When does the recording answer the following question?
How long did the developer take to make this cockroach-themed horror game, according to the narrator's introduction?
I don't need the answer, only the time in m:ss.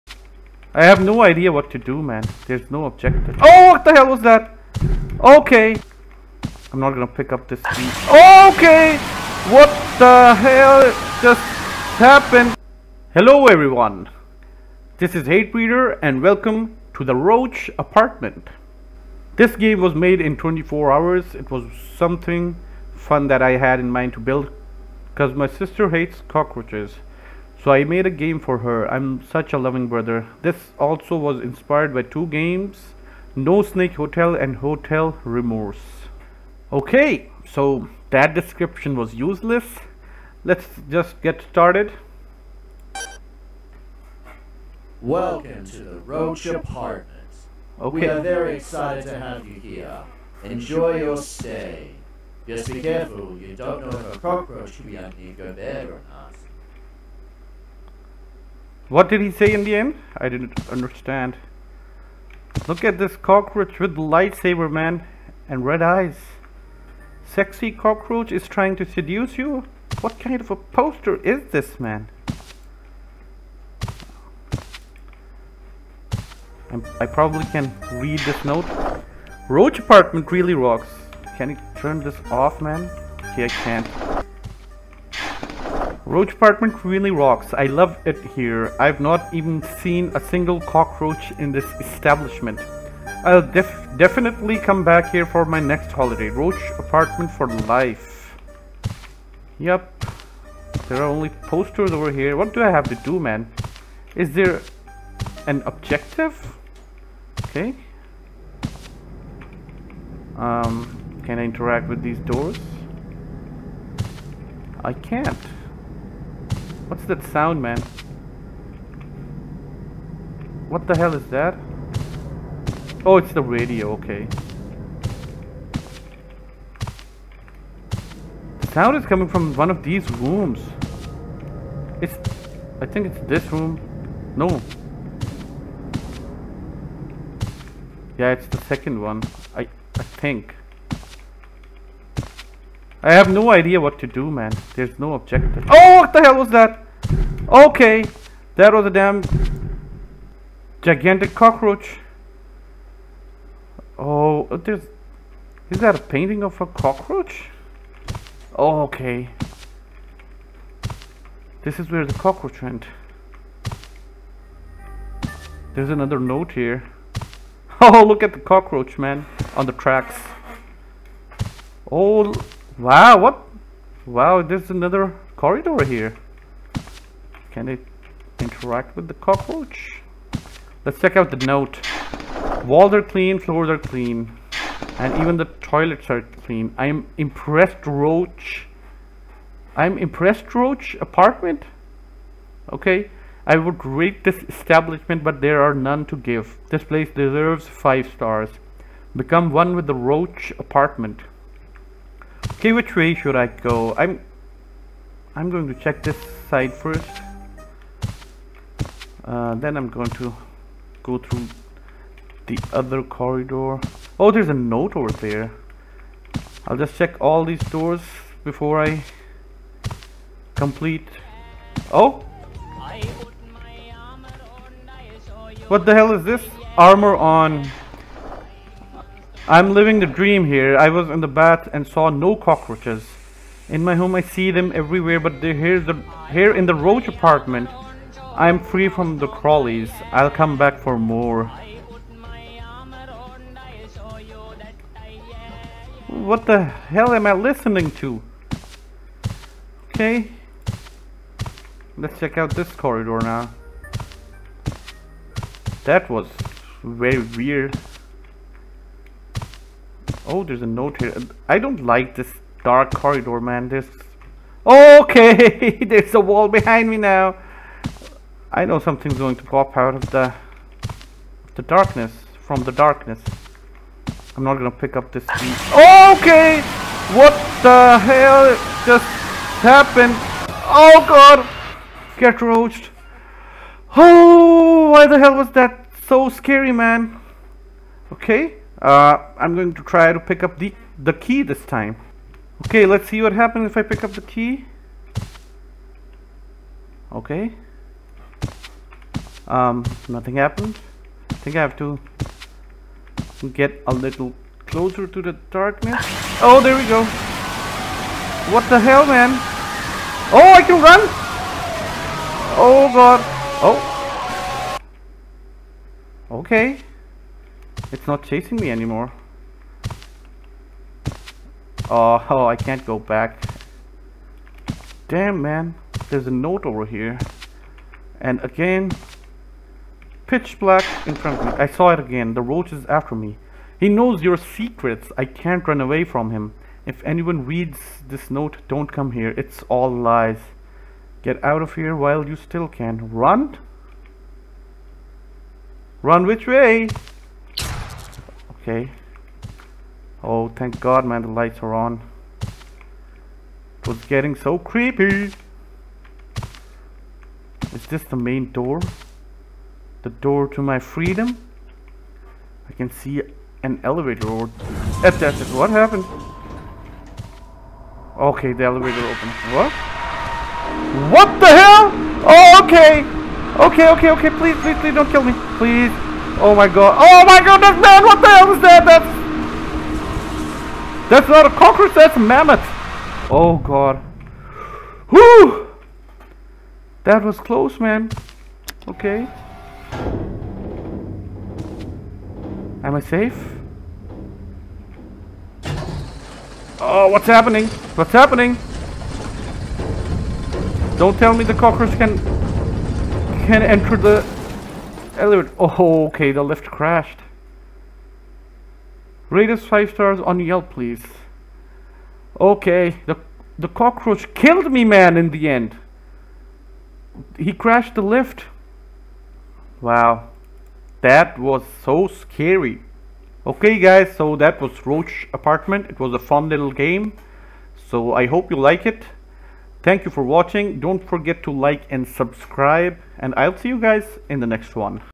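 0:20.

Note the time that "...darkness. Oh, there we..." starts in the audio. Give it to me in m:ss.
5:05.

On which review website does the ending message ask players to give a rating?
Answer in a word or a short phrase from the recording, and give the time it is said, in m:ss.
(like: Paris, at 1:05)
Yelp, at 6:50.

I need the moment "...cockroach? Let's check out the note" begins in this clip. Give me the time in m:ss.
2:59.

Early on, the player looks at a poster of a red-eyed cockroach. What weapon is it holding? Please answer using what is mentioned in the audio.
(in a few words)
Lightsaber.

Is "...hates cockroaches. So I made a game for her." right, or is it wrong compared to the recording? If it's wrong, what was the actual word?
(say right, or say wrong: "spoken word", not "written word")
right.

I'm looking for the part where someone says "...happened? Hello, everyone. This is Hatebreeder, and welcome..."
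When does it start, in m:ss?
0:11.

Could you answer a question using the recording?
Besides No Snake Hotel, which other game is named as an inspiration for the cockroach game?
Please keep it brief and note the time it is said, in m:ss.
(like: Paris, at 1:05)
Hotel Remorse, at 0:34.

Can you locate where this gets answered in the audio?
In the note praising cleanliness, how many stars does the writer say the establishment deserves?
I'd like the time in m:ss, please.
3:17.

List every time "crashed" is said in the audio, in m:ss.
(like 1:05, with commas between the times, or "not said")
6:46, 6:57.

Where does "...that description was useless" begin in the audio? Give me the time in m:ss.
0:38.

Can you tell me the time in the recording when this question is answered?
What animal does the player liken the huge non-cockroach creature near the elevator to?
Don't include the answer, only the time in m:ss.
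6:22.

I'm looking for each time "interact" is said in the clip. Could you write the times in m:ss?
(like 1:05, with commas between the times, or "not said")
1:51, 2:58.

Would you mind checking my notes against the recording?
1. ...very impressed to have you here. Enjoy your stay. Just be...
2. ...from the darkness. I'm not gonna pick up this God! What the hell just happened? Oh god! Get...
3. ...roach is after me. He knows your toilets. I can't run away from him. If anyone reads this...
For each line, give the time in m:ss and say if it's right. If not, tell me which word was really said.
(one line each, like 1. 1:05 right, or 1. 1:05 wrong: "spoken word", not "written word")
1. 0:48 wrong: "excited", not "impressed"
2. 4:32 wrong: "Okay", not "God"
3. 5:32 wrong: "secrets", not "toilets".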